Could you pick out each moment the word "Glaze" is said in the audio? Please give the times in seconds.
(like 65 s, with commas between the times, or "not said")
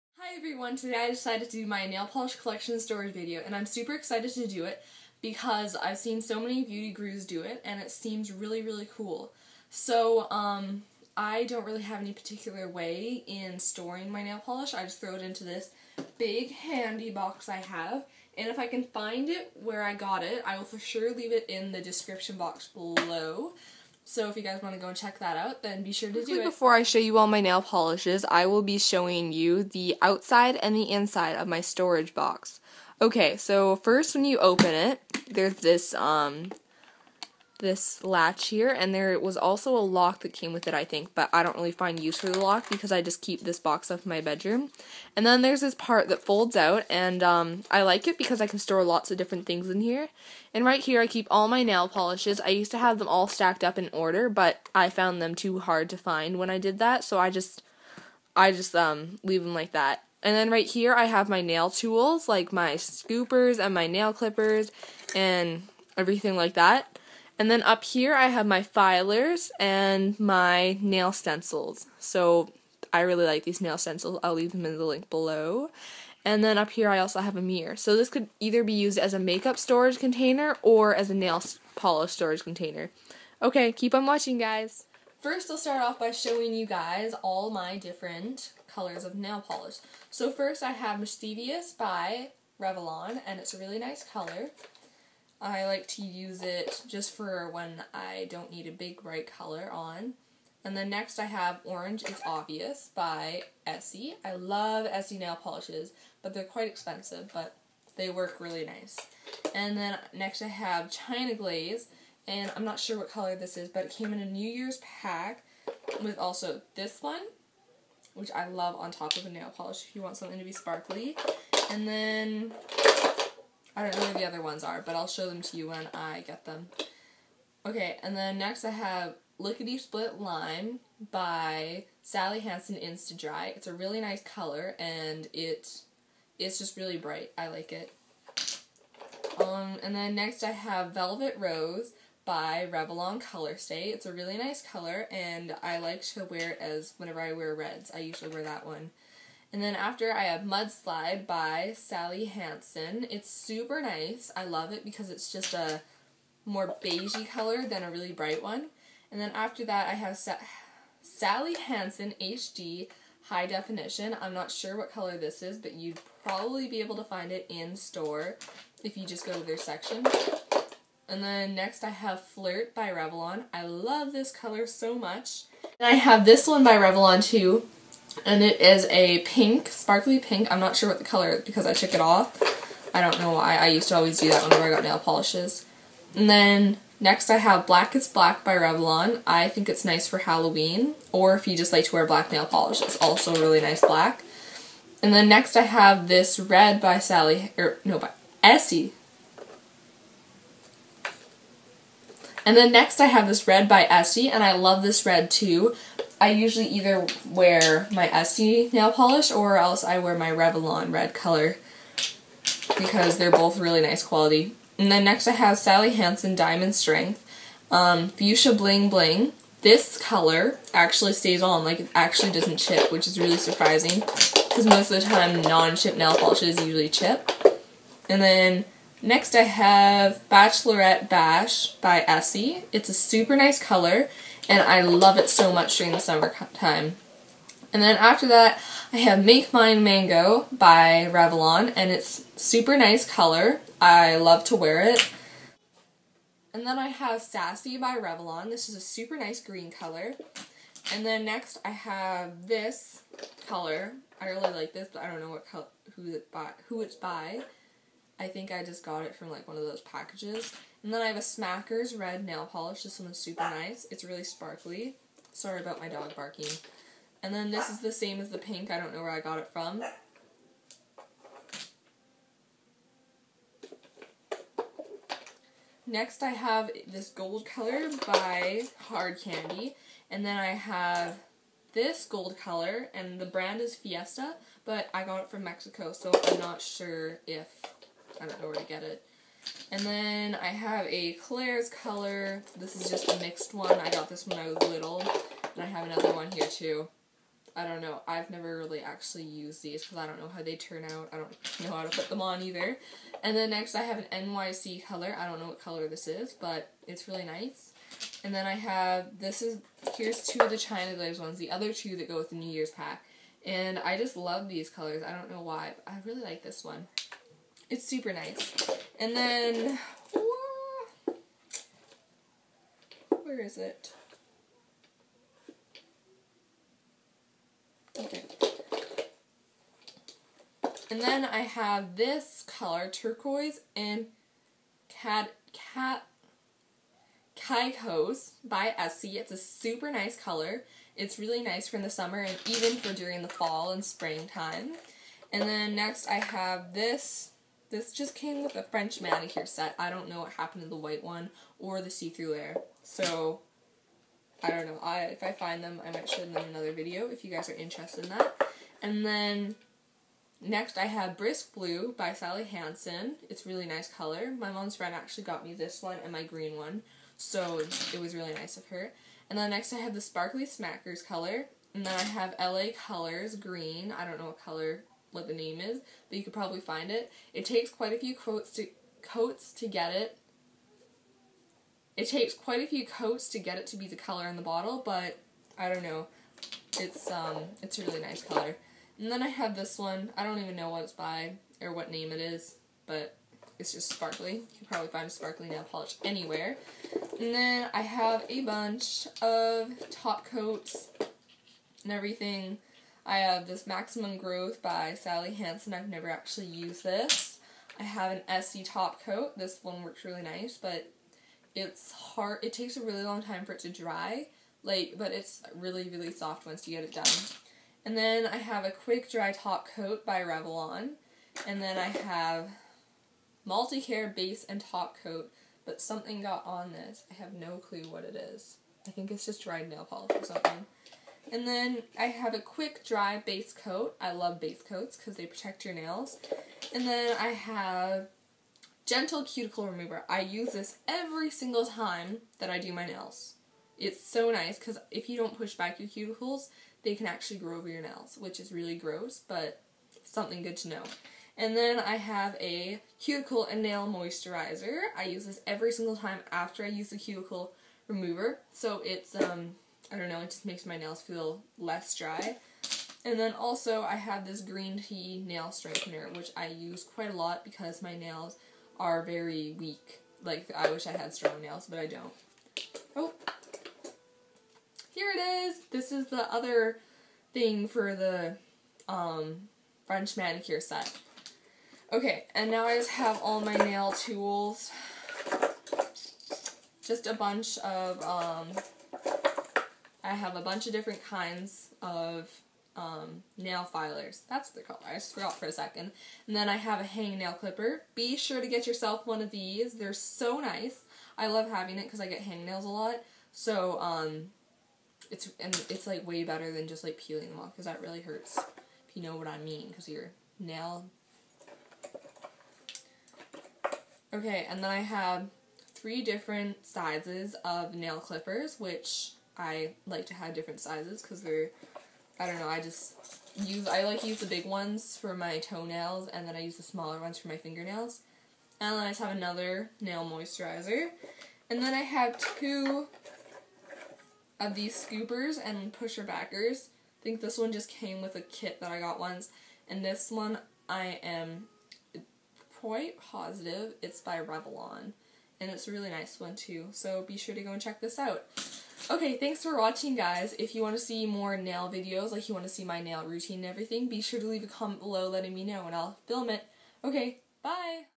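111 s, 310 s.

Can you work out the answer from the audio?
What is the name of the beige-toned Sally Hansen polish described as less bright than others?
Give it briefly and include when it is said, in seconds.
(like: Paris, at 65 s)
Mudslide, at 150 s.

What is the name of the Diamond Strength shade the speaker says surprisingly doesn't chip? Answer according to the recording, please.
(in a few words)
Fuchsia Bling Bling.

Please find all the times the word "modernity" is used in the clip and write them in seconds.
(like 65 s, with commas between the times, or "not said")
not said.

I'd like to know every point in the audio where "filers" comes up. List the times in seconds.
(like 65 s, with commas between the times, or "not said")
68 s, 493 s.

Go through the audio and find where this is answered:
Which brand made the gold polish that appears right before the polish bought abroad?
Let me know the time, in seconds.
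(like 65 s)
278 s.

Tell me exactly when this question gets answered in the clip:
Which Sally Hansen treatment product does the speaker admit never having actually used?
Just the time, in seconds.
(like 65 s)
403 s.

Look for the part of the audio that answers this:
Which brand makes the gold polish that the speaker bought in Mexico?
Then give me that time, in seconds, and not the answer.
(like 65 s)
283 s.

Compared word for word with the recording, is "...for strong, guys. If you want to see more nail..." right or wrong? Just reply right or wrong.
wrong.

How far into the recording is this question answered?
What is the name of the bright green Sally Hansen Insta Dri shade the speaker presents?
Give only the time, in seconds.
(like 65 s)
129 s.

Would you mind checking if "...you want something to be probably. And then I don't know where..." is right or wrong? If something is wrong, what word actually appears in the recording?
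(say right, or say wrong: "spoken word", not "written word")
wrong: "sparkly", not "probably".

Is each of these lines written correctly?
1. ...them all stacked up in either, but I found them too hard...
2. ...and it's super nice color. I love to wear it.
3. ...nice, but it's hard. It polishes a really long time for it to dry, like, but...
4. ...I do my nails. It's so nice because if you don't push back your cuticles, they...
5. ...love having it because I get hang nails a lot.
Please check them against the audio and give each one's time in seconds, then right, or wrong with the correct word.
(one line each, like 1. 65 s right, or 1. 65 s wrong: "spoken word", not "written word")
1. 52 s wrong: "order", not "either"
2. 241 s right
3. 410 s wrong: "takes", not "polishes"
4. 442 s right
5. 501 s right.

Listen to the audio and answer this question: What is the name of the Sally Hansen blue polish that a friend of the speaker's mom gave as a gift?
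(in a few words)
Brisk Blue.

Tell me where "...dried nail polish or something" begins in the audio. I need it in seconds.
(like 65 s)
429 s.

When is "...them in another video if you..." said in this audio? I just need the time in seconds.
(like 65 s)
356 s.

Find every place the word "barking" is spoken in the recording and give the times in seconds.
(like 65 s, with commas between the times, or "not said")
266 s.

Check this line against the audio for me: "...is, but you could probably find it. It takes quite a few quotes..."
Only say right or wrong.
right.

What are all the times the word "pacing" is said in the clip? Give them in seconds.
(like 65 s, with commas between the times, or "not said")
not said.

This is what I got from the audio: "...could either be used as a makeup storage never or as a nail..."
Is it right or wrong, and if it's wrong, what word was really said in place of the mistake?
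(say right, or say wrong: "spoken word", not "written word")
wrong: "container", not "never".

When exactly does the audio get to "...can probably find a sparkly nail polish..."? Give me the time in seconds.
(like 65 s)
394 s.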